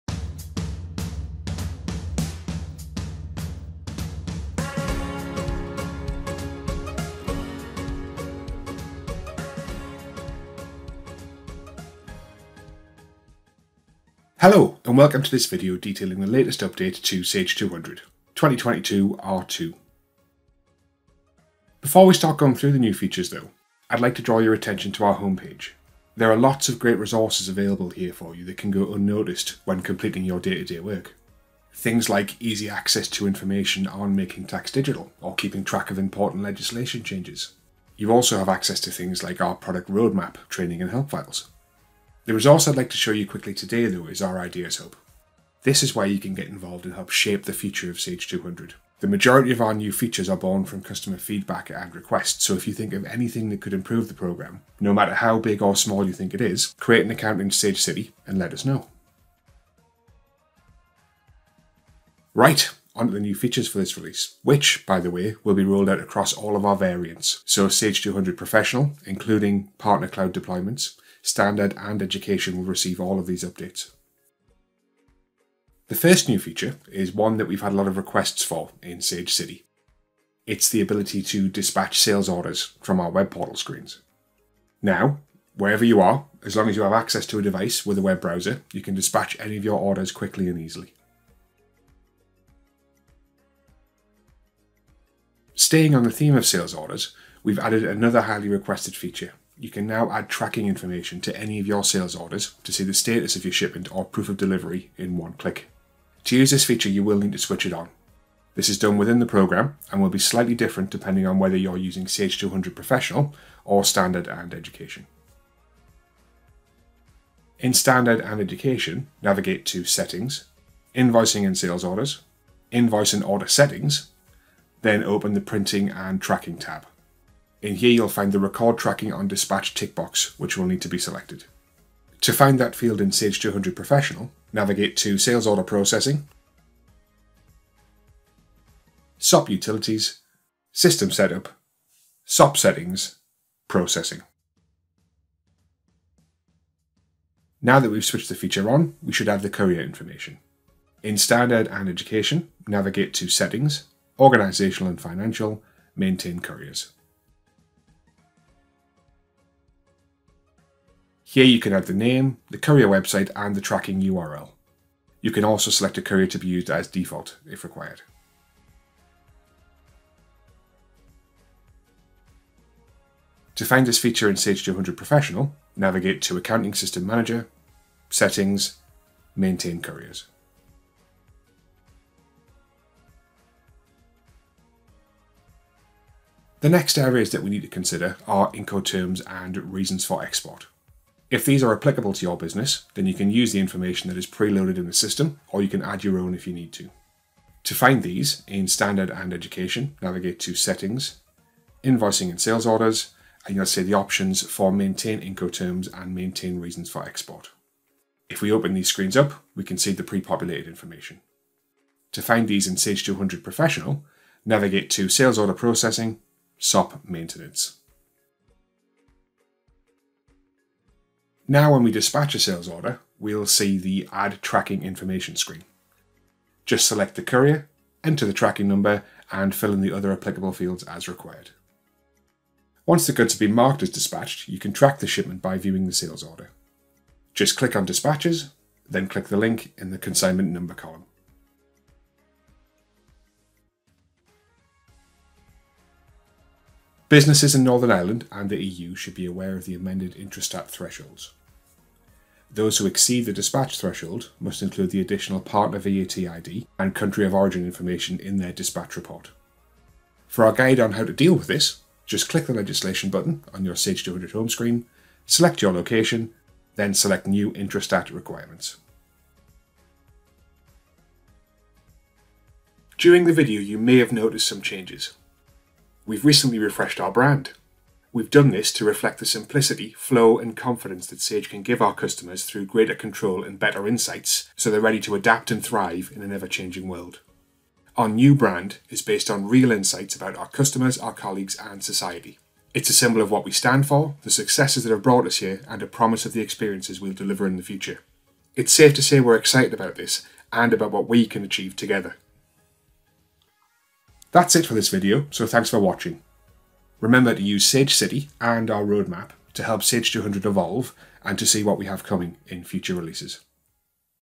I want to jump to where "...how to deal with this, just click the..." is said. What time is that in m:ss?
4:20.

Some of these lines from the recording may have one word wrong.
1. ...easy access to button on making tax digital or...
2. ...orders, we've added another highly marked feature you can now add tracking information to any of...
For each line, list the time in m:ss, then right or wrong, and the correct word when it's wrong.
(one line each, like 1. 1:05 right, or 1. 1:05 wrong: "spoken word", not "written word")
1. 0:32 wrong: "information", not "button"
2. 1:36 wrong: "requested", not "marked".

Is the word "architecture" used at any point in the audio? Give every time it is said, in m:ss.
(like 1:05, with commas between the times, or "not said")
not said.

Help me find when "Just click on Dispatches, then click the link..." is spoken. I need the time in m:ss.
3:57.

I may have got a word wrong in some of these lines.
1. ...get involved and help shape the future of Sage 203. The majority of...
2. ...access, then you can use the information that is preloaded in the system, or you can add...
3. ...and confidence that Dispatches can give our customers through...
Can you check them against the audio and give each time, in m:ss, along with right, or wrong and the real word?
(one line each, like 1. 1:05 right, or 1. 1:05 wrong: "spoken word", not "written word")
1. 0:46 wrong: "200", not "203"
2. 3:12 wrong: "business", not "access"
3. 4:40 wrong: "Sage", not "Dispatches".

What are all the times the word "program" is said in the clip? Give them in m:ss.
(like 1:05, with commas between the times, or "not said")
0:54, 1:49.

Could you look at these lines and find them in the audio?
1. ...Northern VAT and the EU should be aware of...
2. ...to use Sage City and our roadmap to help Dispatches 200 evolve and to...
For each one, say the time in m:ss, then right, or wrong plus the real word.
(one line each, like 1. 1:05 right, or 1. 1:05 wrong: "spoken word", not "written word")
1. 4:07 wrong: "Ireland", not "VAT"
2. 5:07 wrong: "Sage", not "Dispatches".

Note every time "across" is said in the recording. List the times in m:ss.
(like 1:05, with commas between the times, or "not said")
1:05.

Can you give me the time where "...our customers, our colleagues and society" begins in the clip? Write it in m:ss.
4:50.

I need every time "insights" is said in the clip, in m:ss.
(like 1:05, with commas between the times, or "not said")
4:43, 4:49.